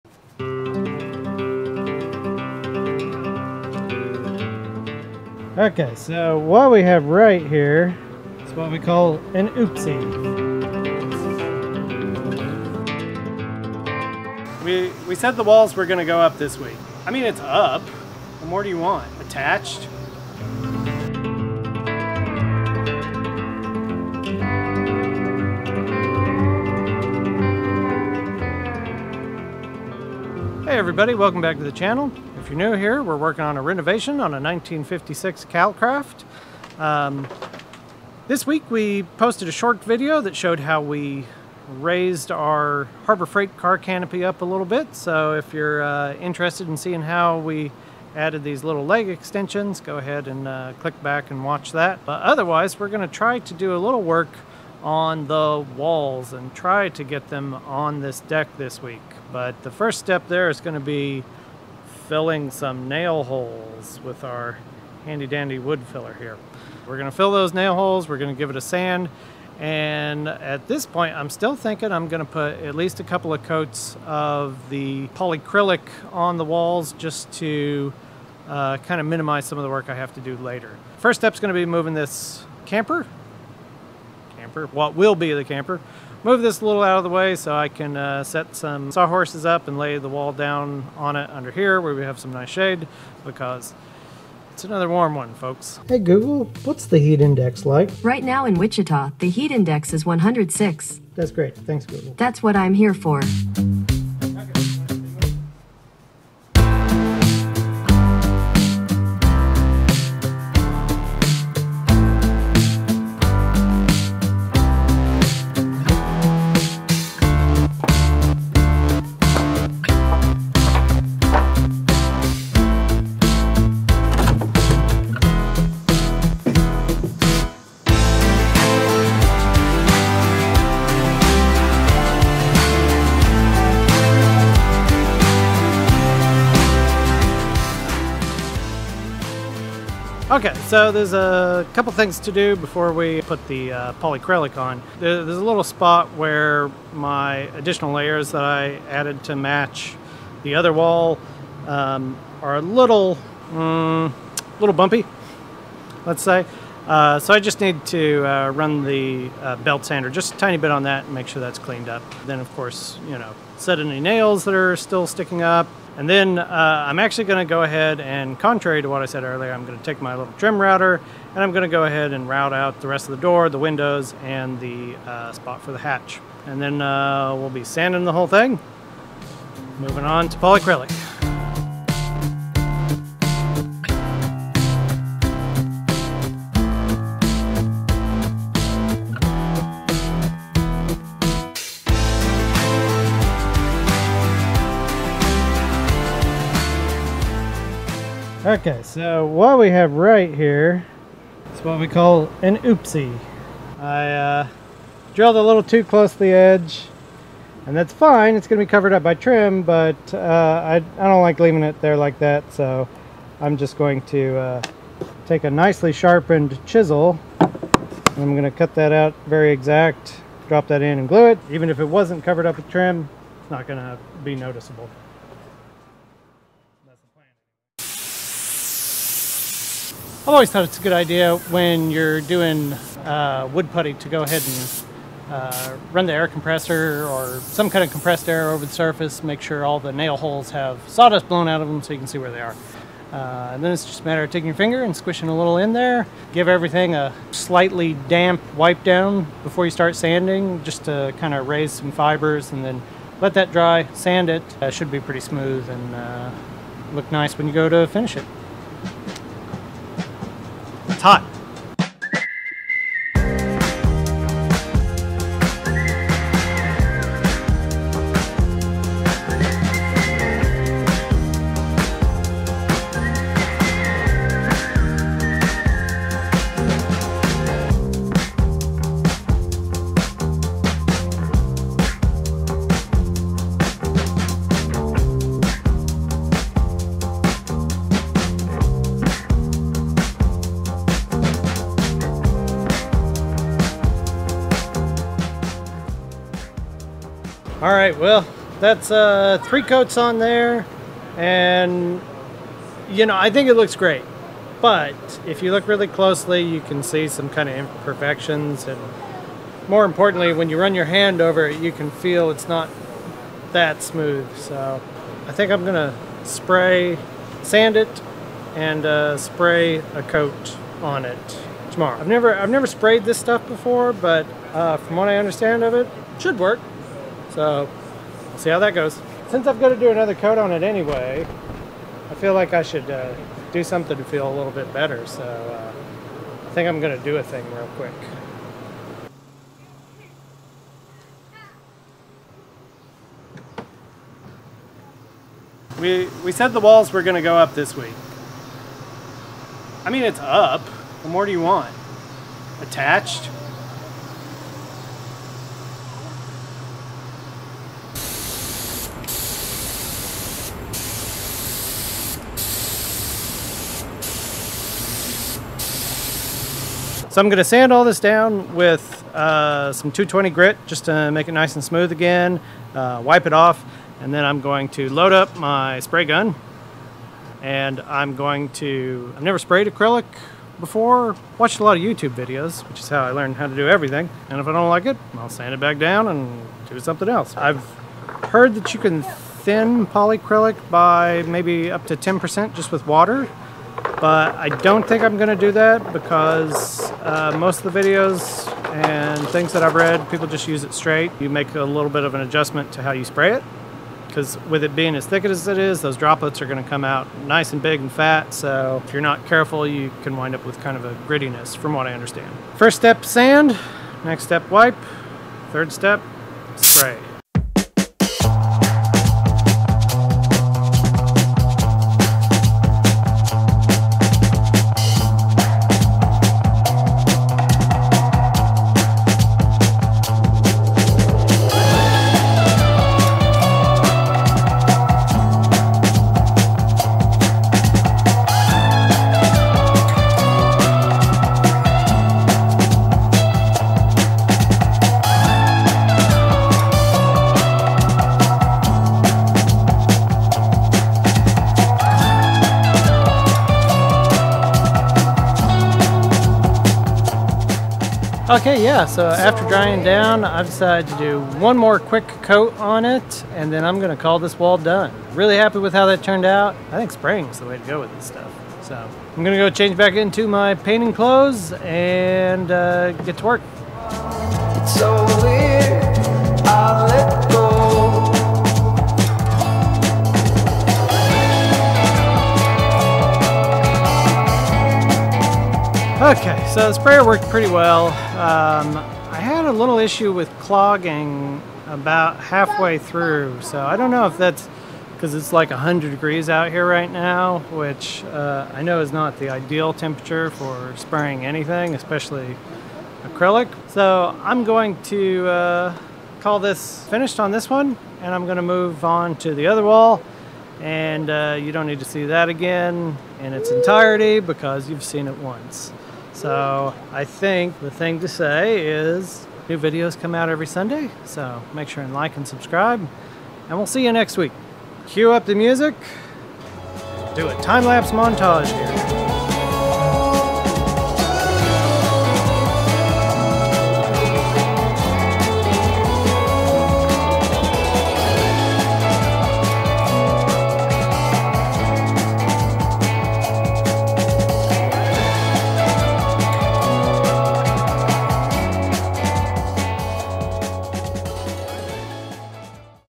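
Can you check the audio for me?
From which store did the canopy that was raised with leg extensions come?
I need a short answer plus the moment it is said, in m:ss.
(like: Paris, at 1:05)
Harbor Freight, at 0:43.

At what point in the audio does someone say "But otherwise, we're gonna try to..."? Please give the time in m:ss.
0:52.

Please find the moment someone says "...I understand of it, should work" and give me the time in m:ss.
5:25.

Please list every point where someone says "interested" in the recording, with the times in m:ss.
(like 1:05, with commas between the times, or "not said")
0:46.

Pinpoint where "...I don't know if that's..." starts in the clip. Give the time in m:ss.
8:13.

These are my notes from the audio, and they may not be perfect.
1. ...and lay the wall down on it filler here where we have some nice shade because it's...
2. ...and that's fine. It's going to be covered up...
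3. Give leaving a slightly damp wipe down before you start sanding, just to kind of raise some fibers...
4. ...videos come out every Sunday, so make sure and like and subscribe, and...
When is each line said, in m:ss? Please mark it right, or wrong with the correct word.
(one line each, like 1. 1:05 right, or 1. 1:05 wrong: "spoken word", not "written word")
1. 1:29 wrong: "under", not "filler"
2. 3:27 right
3. 4:06 wrong: "everything", not "leaving"
4. 8:39 right.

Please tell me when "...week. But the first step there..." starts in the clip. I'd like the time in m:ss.
0:58.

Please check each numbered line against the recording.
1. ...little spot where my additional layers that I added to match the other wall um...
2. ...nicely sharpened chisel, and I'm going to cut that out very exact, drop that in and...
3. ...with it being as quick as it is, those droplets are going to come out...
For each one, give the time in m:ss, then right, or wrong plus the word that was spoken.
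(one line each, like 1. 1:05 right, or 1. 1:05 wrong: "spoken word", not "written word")
1. 2:25 right
2. 3:35 right
3. 6:44 wrong: "thick", not "quick".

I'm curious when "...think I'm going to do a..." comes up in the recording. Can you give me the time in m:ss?
5:36.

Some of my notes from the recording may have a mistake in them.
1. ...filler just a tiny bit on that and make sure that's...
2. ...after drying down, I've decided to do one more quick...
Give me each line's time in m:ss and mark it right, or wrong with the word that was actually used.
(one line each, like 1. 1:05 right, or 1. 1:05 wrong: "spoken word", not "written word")
1. 2:39 wrong: "sander", not "filler"
2. 7:39 right.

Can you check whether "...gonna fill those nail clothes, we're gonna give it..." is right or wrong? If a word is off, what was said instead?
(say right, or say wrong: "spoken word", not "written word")
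wrong: "holes", not "clothes".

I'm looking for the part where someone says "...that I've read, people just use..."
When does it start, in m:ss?
6:39.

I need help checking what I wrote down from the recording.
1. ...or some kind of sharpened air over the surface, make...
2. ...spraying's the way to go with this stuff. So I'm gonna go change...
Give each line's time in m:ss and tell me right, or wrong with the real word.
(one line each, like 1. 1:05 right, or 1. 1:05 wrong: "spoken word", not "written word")
1. 3:57 wrong: "compressed", not "sharpened"
2. 7:46 right.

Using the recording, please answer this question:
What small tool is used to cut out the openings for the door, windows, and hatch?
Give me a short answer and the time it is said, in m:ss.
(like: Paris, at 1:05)
trim router, at 2:50.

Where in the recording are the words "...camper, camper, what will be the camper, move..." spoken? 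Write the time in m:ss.
1:22.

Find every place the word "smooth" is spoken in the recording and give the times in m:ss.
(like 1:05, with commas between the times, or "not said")
4:15, 5:13, 6:11.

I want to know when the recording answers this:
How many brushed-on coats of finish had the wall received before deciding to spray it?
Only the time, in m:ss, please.
4:59.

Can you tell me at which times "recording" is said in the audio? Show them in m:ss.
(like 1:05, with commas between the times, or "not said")
not said.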